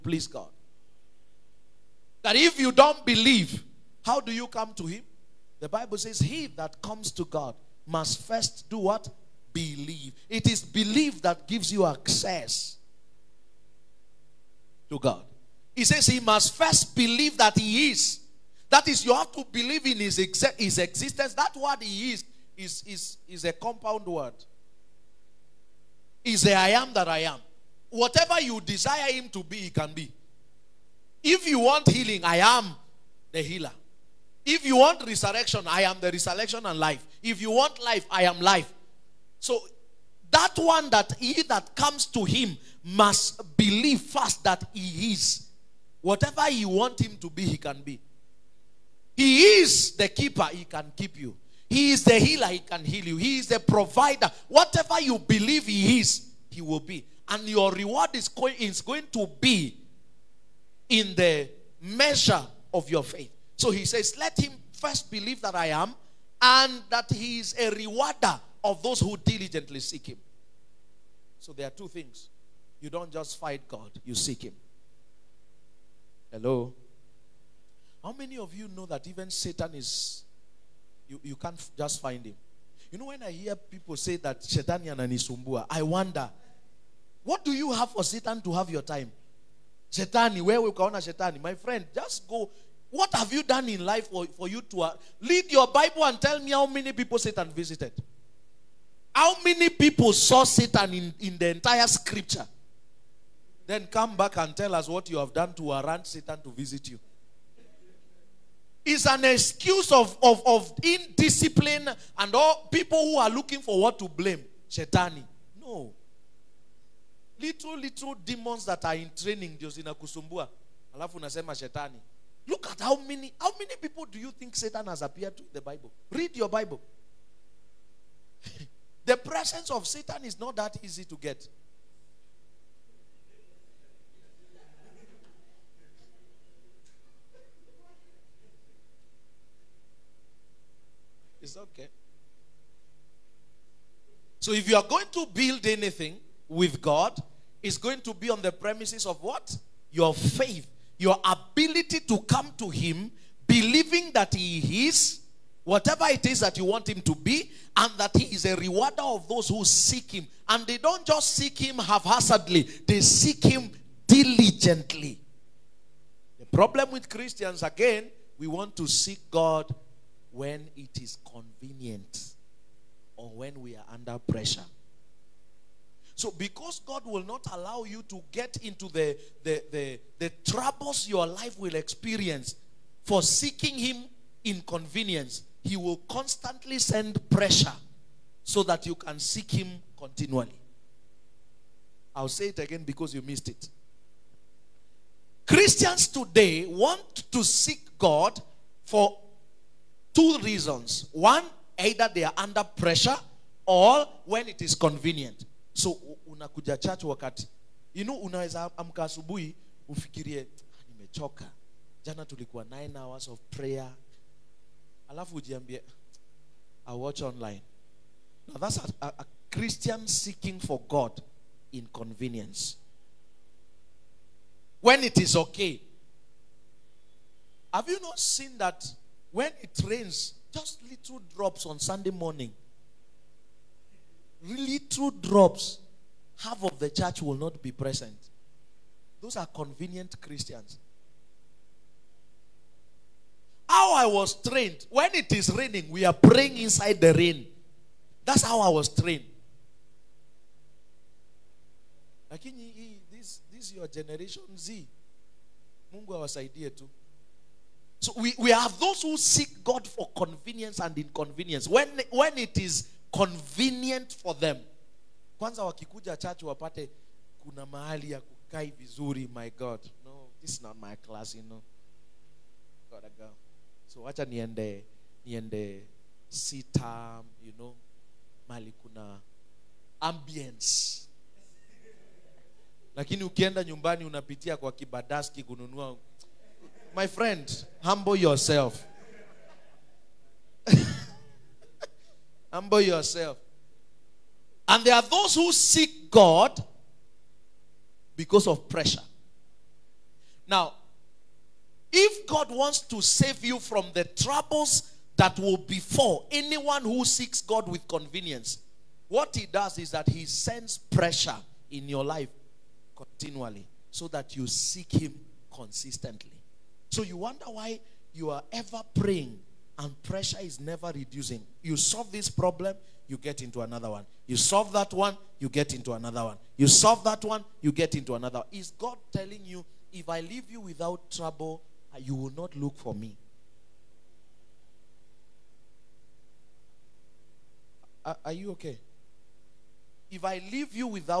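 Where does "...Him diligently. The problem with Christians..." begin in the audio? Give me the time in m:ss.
2:43.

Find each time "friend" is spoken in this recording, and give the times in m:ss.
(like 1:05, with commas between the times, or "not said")
1:31, 4:47.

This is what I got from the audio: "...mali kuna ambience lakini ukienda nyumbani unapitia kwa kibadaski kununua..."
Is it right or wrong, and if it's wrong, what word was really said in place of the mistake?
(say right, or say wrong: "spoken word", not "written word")
right.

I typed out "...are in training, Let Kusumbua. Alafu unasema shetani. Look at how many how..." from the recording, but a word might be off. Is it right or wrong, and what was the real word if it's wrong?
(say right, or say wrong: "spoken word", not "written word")
wrong: "Josina", not "Let".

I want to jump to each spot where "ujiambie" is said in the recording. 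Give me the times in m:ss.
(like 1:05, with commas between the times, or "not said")
3:35.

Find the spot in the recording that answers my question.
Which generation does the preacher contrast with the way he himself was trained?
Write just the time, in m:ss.
4:13.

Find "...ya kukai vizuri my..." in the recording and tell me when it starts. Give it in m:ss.
4:28.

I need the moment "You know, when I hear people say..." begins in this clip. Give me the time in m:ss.
1:22.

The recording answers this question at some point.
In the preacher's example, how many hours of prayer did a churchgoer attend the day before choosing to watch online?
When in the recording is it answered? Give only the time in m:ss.
3:32.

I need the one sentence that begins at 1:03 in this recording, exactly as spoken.
So he says, Let him first believe that I am and that he is a rewarder of those who diligently seek him.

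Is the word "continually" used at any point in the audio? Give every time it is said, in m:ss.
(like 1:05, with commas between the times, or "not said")
3:09, 5:12.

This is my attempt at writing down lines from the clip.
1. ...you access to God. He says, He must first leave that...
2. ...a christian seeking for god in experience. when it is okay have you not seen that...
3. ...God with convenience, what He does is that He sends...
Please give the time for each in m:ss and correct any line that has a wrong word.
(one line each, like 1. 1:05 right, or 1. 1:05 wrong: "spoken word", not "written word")
1. 0:11 wrong: "believe", not "leave"
2. 3:39 wrong: "convenience", not "experience"
3. 5:07 right.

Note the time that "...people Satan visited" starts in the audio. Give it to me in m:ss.
1:36.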